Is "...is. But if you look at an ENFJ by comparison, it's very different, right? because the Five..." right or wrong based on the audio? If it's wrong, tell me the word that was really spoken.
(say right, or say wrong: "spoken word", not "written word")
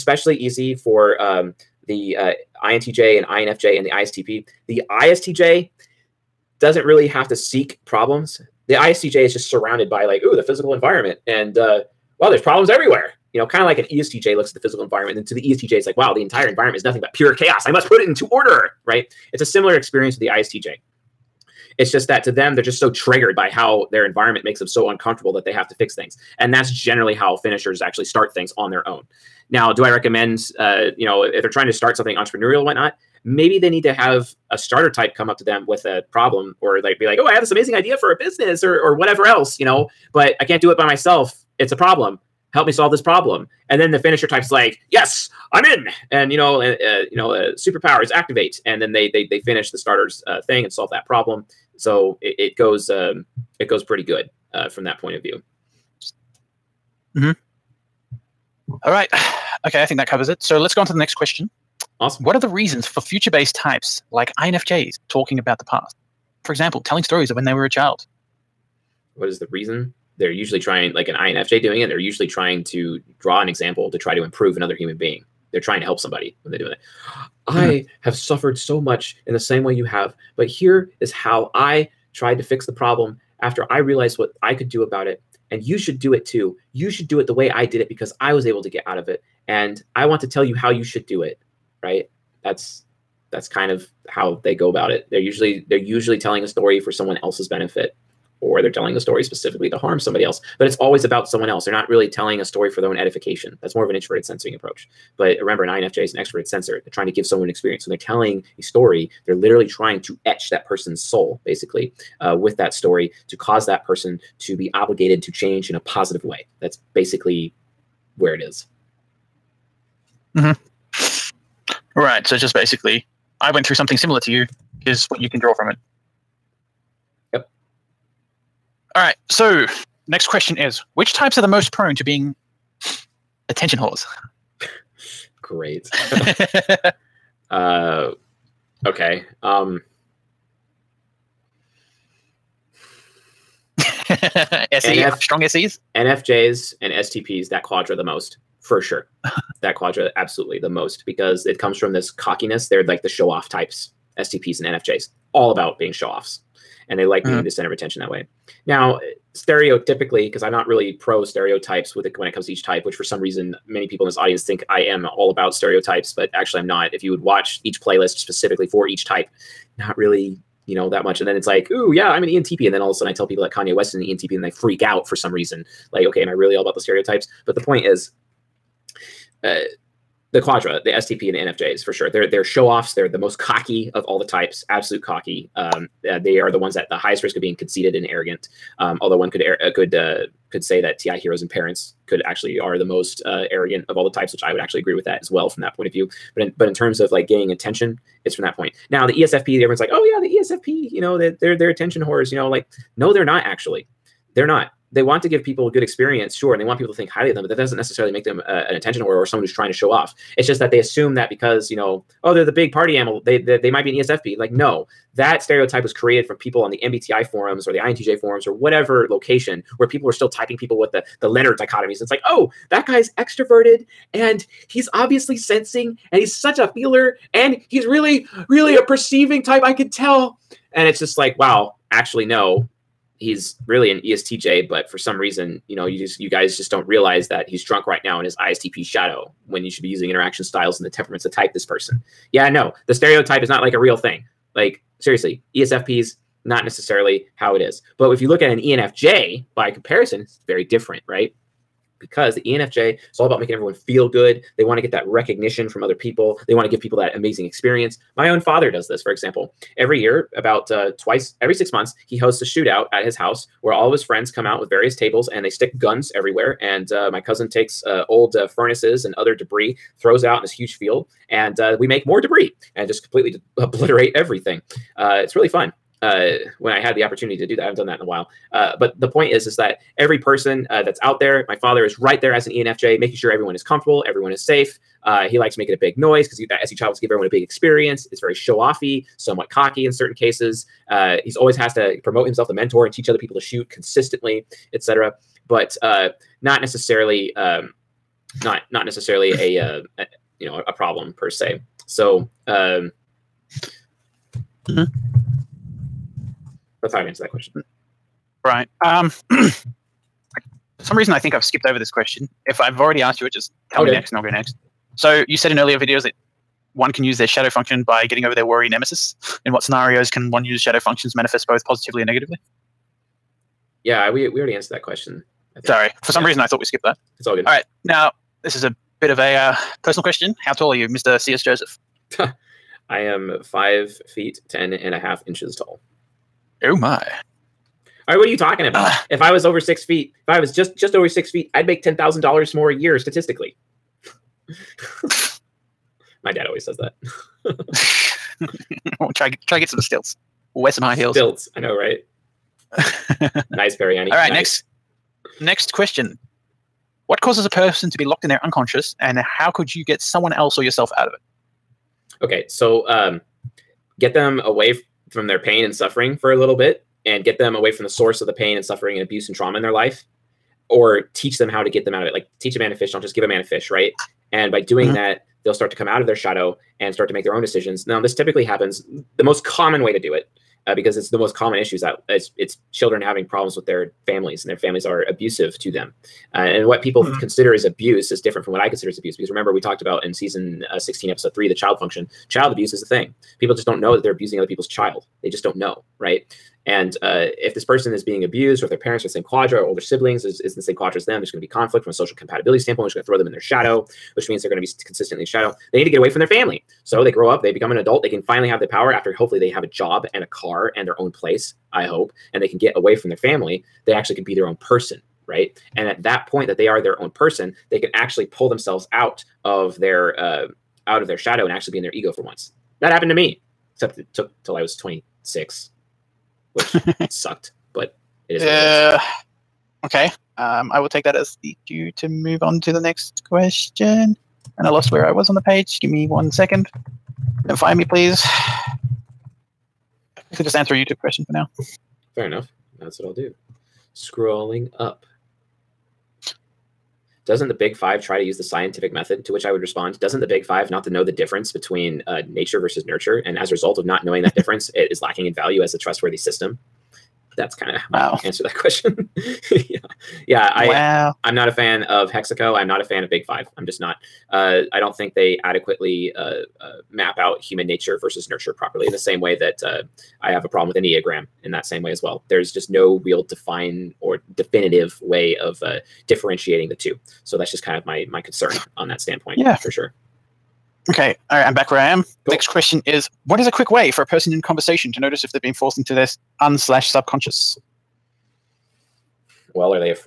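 wrong: "ENFJ", not "Five".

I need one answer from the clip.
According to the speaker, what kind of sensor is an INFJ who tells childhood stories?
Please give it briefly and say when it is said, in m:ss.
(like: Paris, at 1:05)
Extroverted sensor, at 1:46.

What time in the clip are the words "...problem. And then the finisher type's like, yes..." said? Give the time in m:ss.
0:42.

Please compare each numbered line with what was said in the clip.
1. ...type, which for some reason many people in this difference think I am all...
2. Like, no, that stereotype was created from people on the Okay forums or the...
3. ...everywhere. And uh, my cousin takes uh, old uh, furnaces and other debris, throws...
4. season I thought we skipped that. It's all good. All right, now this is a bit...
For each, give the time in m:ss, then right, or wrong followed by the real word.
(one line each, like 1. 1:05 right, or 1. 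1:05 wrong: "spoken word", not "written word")
1. 2:42 wrong: "audience", not "difference"
2. 3:34 wrong: "MBTI", not "Okay"
3. 4:26 right
4. 5:26 wrong: "reason", not "season".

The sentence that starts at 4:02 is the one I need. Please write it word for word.
Yeah, no, the stereotype is not like a real thing.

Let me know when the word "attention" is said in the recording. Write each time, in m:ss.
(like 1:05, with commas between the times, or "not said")
2:13, 2:37, 3:17, 3:21, 3:28.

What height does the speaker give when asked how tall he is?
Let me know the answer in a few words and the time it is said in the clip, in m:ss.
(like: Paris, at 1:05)
5 feet 10.5 inches, at 5:33.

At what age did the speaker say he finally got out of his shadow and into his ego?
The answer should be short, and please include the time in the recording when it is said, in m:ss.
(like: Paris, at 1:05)
26, at 7:04.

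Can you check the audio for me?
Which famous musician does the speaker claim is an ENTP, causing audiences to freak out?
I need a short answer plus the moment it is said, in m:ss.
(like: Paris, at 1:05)
Kanye West, at 2:53.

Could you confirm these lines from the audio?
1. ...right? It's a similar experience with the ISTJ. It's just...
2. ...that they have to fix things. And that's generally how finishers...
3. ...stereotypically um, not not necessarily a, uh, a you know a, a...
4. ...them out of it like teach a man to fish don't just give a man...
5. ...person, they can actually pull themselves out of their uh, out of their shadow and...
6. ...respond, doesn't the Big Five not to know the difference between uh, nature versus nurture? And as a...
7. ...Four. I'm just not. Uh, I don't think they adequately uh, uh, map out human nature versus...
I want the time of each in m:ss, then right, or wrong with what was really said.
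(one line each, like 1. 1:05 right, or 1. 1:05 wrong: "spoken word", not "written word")
1. 0:18 right
2. 0:25 right
3. 4:56 wrong: "necessarily", not "stereotypically"
4. 6:11 right
5. 6:57 right
6. 7:29 right
7. 7:43 wrong: "Five", not "Four".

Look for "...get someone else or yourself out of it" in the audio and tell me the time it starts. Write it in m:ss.
5:59.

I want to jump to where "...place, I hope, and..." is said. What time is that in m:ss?
6:51.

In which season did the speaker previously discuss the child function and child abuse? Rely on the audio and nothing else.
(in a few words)
Season 16.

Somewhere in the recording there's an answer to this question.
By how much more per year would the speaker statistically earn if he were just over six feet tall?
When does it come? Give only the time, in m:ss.
5:41.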